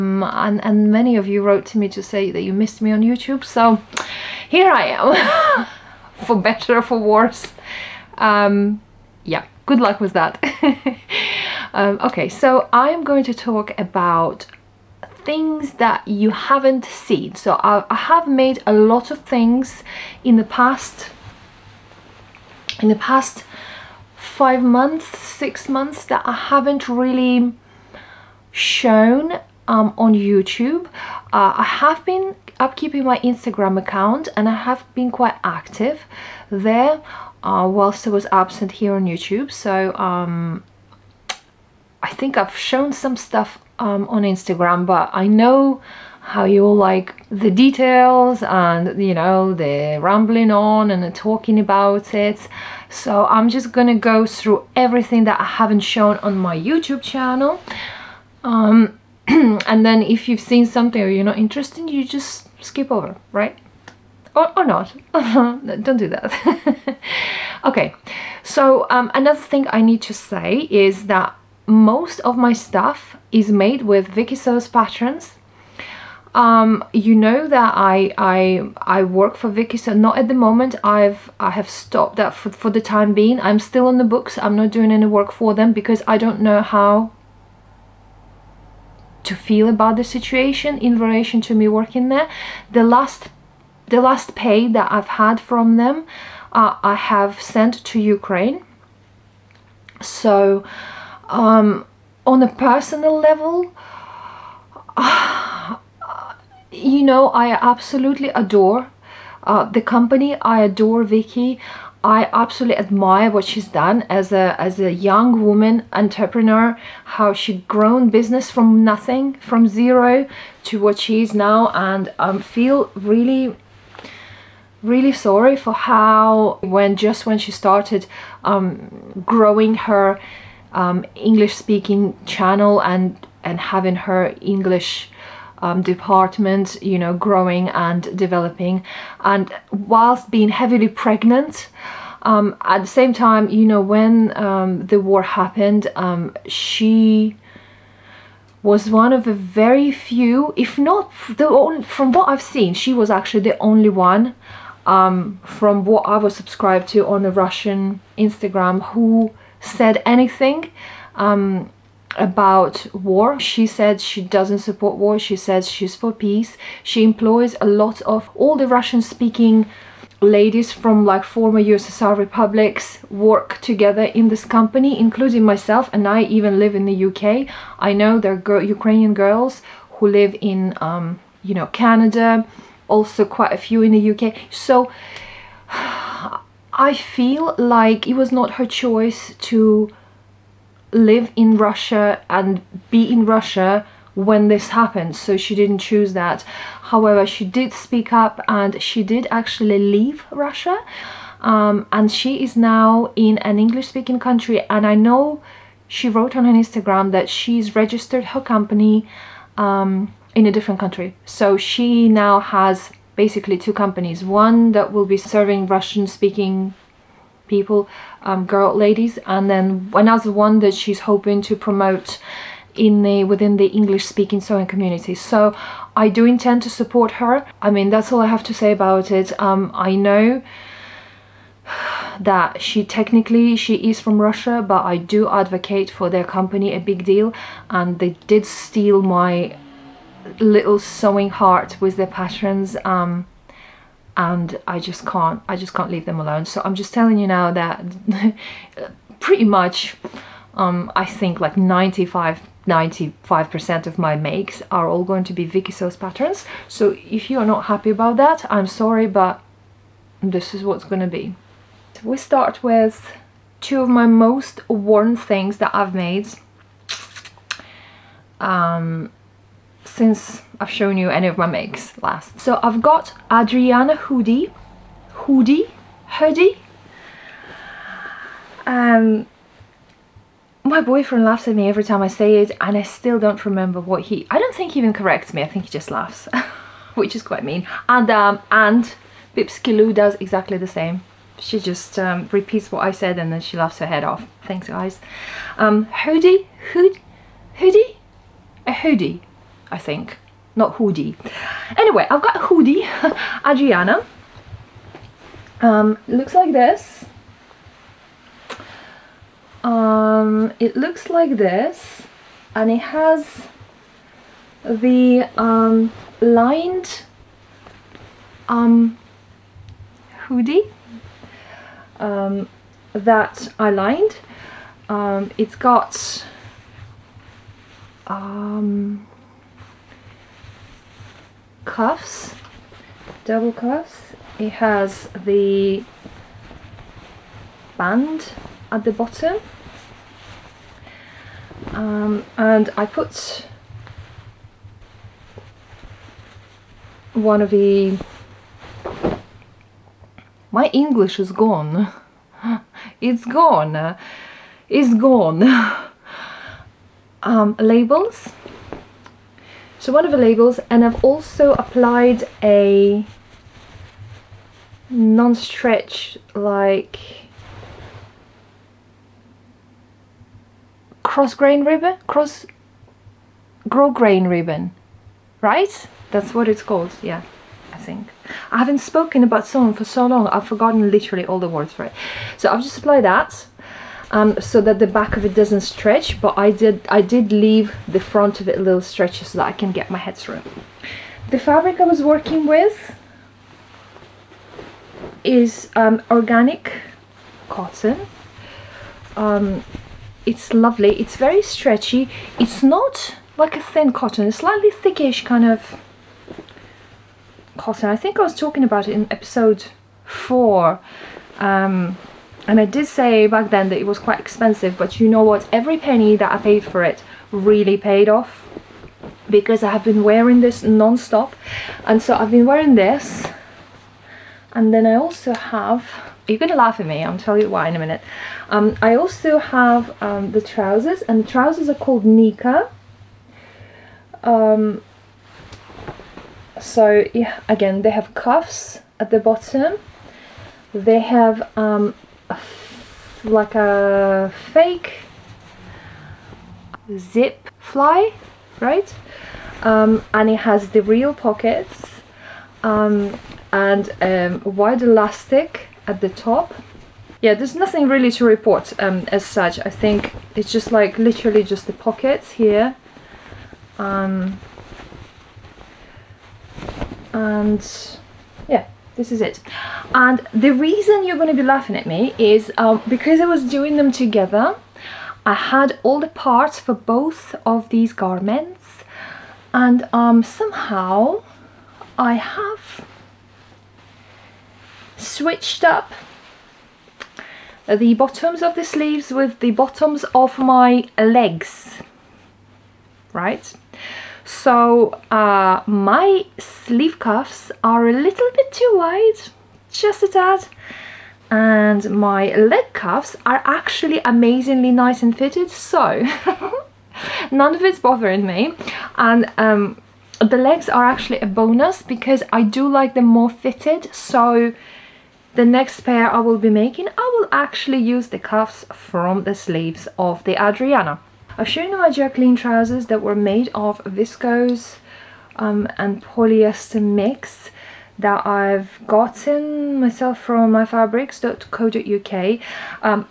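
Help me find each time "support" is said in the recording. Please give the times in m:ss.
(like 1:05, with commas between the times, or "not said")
2:44, 3:46.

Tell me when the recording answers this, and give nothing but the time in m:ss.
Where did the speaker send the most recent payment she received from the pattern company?
1:38.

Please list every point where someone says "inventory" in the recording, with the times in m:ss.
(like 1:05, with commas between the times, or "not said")
not said.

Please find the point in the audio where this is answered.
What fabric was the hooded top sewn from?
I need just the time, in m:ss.
6:36.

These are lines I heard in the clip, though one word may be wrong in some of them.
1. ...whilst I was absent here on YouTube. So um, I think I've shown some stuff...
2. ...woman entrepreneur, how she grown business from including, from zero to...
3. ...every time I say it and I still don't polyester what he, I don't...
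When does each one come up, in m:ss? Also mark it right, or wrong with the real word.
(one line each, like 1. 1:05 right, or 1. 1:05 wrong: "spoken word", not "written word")
1. 0:37 right
2. 1:55 wrong: "nothing", not "including"
3. 4:41 wrong: "remember", not "polyester".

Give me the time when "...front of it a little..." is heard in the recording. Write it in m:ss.
6:27.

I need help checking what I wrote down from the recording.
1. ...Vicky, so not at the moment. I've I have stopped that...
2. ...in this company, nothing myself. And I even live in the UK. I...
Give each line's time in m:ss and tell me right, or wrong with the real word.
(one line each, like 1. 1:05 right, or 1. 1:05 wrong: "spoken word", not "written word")
1. 1:19 right
2. 2:54 wrong: "including", not "nothing".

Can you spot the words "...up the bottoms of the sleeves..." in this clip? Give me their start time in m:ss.
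8:05.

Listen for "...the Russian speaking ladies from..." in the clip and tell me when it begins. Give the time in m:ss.
2:48.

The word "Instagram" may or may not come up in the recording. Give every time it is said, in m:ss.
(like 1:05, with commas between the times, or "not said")
0:33, 0:44, 2:38, 3:26.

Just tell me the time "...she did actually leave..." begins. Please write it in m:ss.
3:18.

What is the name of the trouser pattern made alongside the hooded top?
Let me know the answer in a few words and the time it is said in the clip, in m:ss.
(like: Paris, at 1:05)
Nika, at 7:12.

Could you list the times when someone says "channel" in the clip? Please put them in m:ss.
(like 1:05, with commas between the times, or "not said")
0:57, 2:12.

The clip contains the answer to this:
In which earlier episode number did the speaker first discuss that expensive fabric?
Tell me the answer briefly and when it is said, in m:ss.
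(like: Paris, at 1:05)
4, at 6:49.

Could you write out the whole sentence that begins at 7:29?
Um, and it has the real pockets um, and um, wide elastic at the top.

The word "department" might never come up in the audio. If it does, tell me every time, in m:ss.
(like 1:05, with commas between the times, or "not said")
2:15.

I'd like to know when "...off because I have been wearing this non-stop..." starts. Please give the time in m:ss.
6:58.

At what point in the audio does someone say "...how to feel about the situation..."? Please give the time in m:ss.
1:26.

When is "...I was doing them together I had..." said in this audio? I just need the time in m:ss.
7:53.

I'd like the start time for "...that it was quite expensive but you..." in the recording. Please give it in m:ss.
6:53.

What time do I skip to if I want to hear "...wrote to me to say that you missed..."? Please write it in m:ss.
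0:01.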